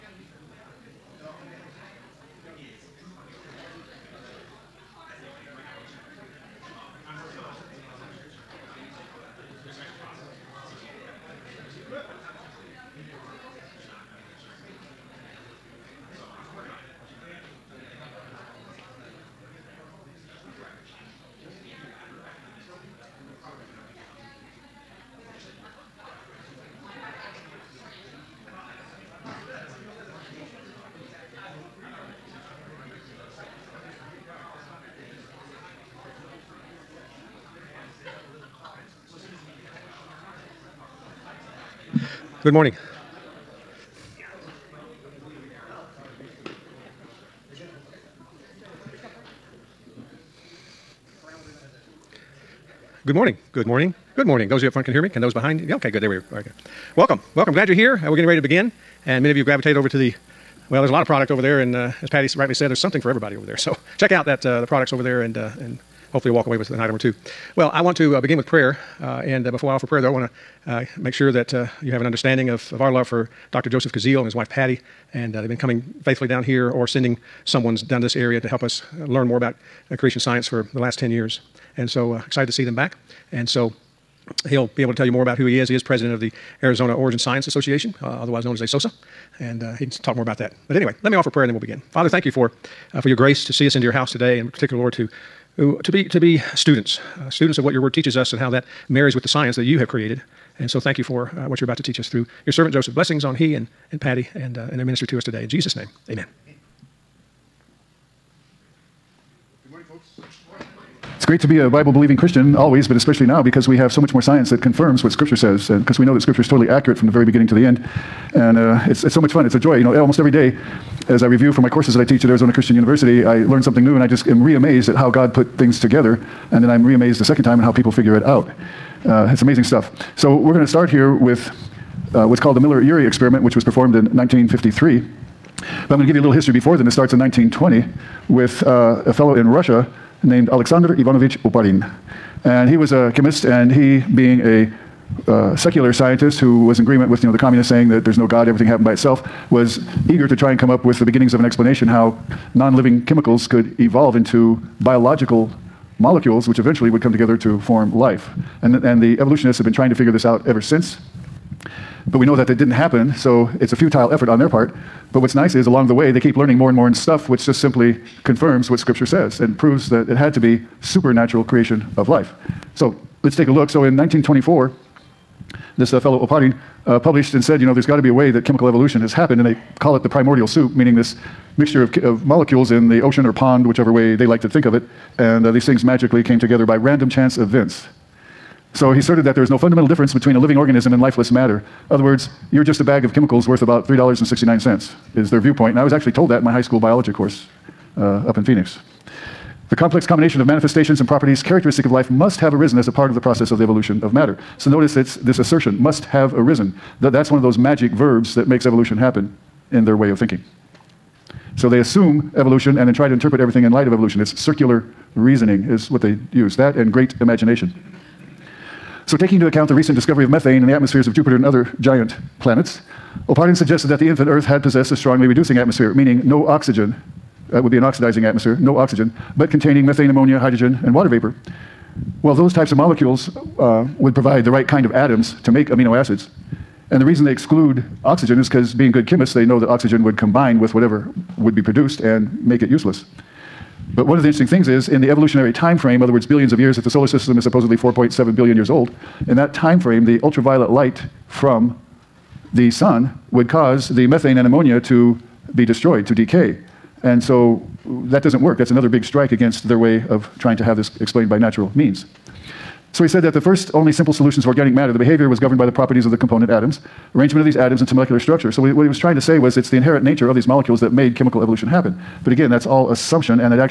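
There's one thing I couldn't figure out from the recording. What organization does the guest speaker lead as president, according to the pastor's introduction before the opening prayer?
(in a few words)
Arizona Origin Science Association.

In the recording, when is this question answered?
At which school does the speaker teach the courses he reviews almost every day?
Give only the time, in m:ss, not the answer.
2:02.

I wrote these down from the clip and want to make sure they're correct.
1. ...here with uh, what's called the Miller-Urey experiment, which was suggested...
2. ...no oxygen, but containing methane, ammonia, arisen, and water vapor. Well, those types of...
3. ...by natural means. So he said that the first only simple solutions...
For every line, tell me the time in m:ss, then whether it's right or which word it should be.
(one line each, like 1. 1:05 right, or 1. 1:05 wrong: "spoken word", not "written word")
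1. 2:10 wrong: "performed", not "suggested"
2. 3:48 wrong: "hydrogen", not "arisen"
3. 4:21 right.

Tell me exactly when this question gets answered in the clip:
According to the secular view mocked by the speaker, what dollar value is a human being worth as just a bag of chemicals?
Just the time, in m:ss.
3:13.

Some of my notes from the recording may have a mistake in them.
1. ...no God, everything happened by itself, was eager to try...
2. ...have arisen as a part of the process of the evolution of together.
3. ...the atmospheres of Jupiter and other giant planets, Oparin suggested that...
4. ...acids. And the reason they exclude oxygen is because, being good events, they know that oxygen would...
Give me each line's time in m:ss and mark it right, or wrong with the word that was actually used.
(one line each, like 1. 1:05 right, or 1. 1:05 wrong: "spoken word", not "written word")
1. 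2:28 right
2. 3:22 wrong: "matter", not "together"
3. 3:40 right
4. 3:55 wrong: "chemists", not "events".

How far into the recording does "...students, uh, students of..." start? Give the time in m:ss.
1:36.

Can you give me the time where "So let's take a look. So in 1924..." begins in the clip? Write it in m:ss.
2:52.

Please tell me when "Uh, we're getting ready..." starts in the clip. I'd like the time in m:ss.
0:58.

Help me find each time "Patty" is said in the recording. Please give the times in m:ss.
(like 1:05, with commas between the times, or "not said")
1:02, 1:14, 1:44.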